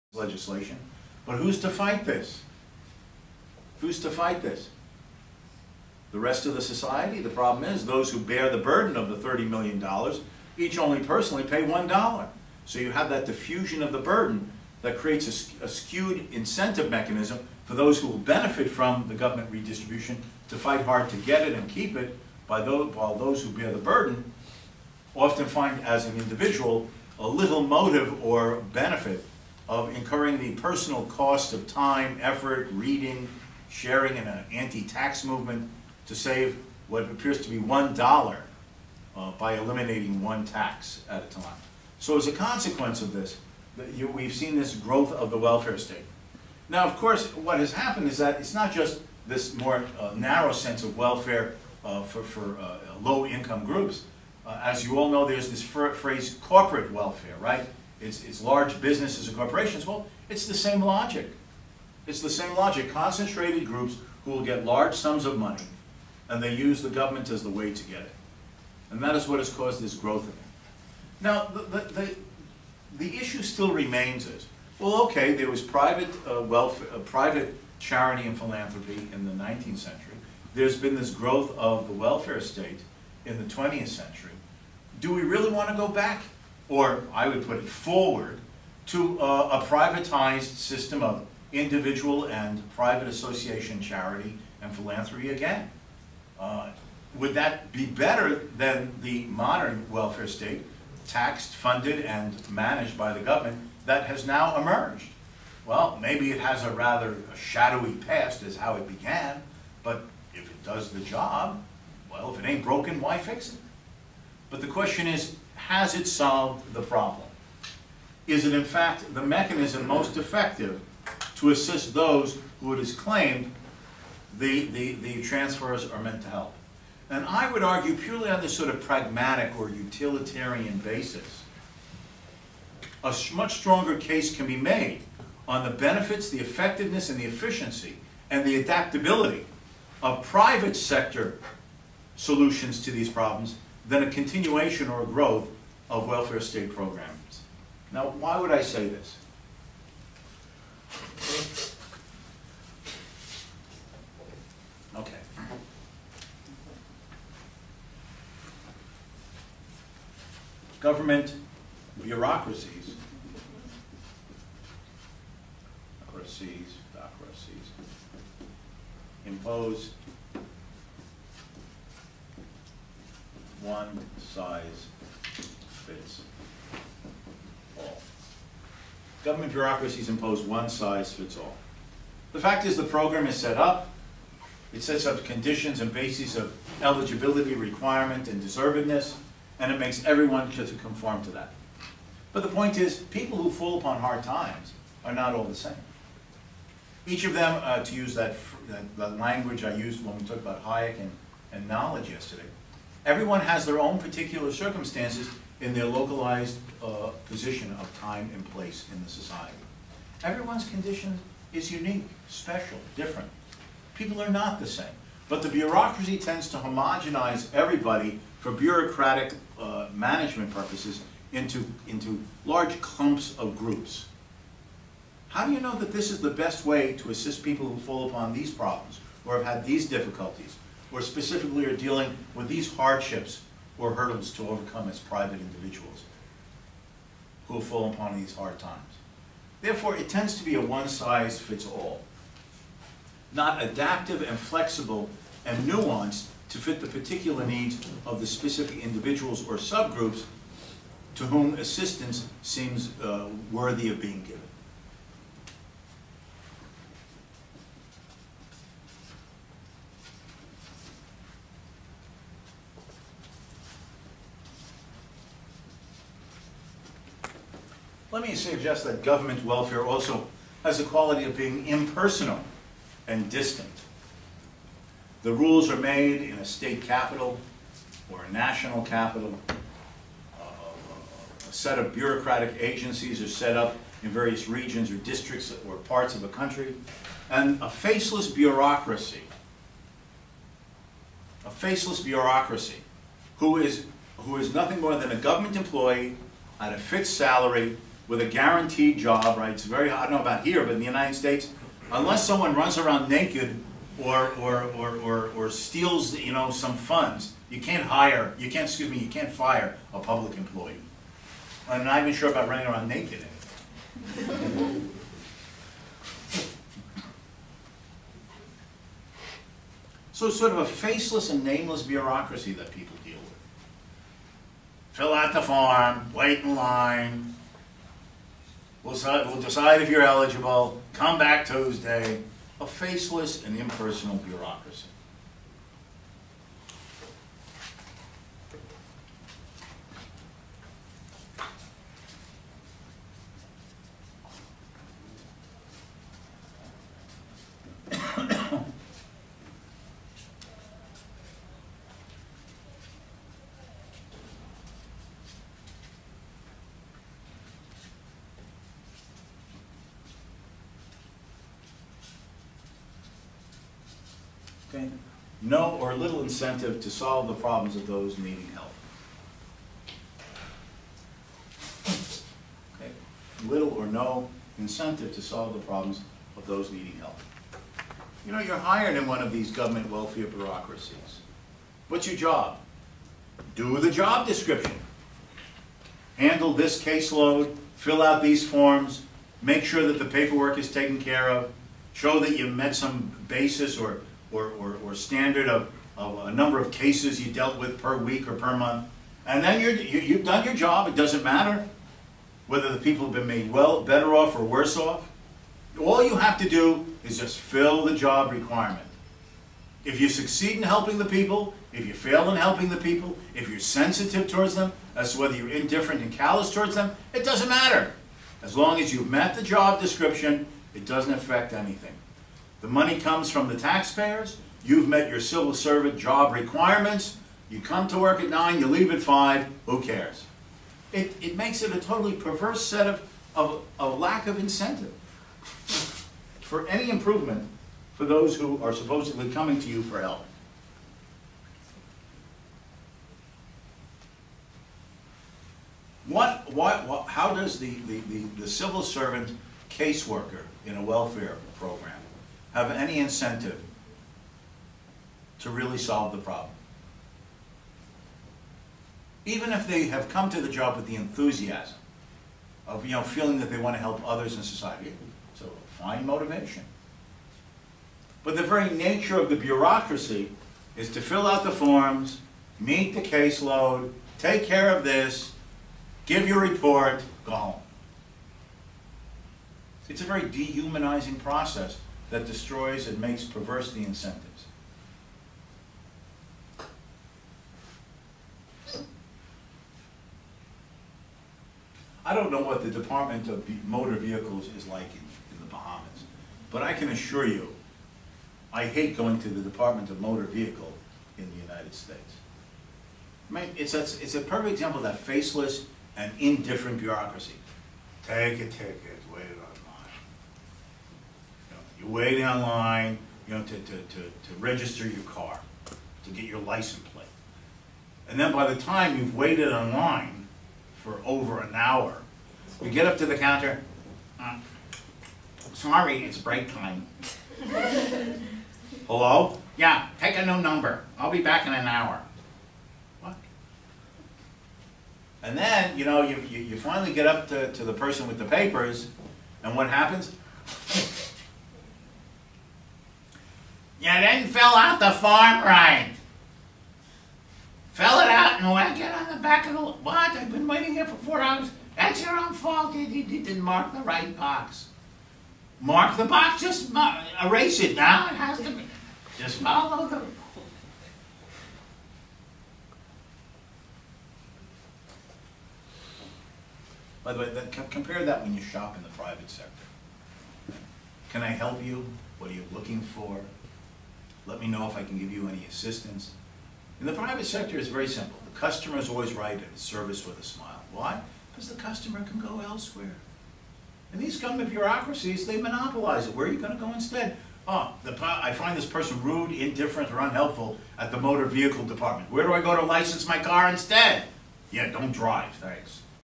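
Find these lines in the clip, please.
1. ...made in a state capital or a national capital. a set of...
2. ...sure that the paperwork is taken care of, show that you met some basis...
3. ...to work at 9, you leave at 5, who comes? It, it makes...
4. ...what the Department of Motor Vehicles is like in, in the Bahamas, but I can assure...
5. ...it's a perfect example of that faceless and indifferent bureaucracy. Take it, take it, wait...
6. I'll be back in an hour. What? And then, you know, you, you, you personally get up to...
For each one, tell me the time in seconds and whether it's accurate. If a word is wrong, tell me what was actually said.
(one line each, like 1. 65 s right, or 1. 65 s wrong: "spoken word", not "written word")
1. 275 s right
2. 389 s right
3. 427 s wrong: "cares", not "comes"
4. 492 s right
5. 503 s right
6. 530 s wrong: "finally", not "personally".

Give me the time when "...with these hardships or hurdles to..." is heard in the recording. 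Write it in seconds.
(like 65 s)
232 s.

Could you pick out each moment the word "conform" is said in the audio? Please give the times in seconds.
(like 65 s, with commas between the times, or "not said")
190 s.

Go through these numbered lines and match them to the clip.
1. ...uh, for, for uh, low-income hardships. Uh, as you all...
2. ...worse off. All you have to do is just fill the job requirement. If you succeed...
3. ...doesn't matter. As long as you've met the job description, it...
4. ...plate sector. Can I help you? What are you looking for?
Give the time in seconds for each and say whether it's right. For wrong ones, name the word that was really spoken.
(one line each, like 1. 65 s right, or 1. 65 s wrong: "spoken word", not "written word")
1. 51 s wrong: "groups", not "hardships"
2. 404 s right
3. 417 s right
4. 568 s wrong: "private", not "plate".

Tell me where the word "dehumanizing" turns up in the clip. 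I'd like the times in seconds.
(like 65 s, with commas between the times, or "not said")
480 s.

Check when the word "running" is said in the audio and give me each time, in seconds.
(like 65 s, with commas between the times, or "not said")
312 s.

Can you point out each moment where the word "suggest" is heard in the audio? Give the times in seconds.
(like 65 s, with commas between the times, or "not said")
268 s.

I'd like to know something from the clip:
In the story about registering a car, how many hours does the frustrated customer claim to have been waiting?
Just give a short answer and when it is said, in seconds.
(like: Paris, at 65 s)
4, at 550 s.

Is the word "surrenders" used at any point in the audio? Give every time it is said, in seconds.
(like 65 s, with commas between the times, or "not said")
not said.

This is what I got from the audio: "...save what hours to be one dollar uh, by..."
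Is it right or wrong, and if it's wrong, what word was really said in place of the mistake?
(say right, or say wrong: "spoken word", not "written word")
wrong: "appears", not "hours".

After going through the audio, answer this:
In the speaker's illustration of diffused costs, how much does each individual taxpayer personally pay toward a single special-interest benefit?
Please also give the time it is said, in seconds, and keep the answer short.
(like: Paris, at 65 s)
$1, at 11 s.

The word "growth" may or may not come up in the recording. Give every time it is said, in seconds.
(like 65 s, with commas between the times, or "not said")
44 s, 69 s, 81 s, 145 s.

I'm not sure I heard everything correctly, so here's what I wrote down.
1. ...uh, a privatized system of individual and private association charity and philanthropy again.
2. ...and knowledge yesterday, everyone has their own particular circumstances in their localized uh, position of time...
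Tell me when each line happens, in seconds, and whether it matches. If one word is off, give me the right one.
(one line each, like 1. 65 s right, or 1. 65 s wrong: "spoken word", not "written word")
1. 89 s right
2. 201 s right.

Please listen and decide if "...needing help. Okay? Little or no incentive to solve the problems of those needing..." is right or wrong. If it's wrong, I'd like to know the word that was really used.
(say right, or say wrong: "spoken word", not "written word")
right.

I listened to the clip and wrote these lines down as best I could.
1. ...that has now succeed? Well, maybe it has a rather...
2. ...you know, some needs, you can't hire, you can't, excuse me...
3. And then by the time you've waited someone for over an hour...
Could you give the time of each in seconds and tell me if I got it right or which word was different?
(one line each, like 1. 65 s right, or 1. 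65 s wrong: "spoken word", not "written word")
1. 103 s wrong: "emerged", not "succeed"
2. 306 s wrong: "funds", not "needs"
3. 518 s wrong: "online", not "someone".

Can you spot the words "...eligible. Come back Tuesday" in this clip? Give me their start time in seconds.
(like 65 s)
330 s.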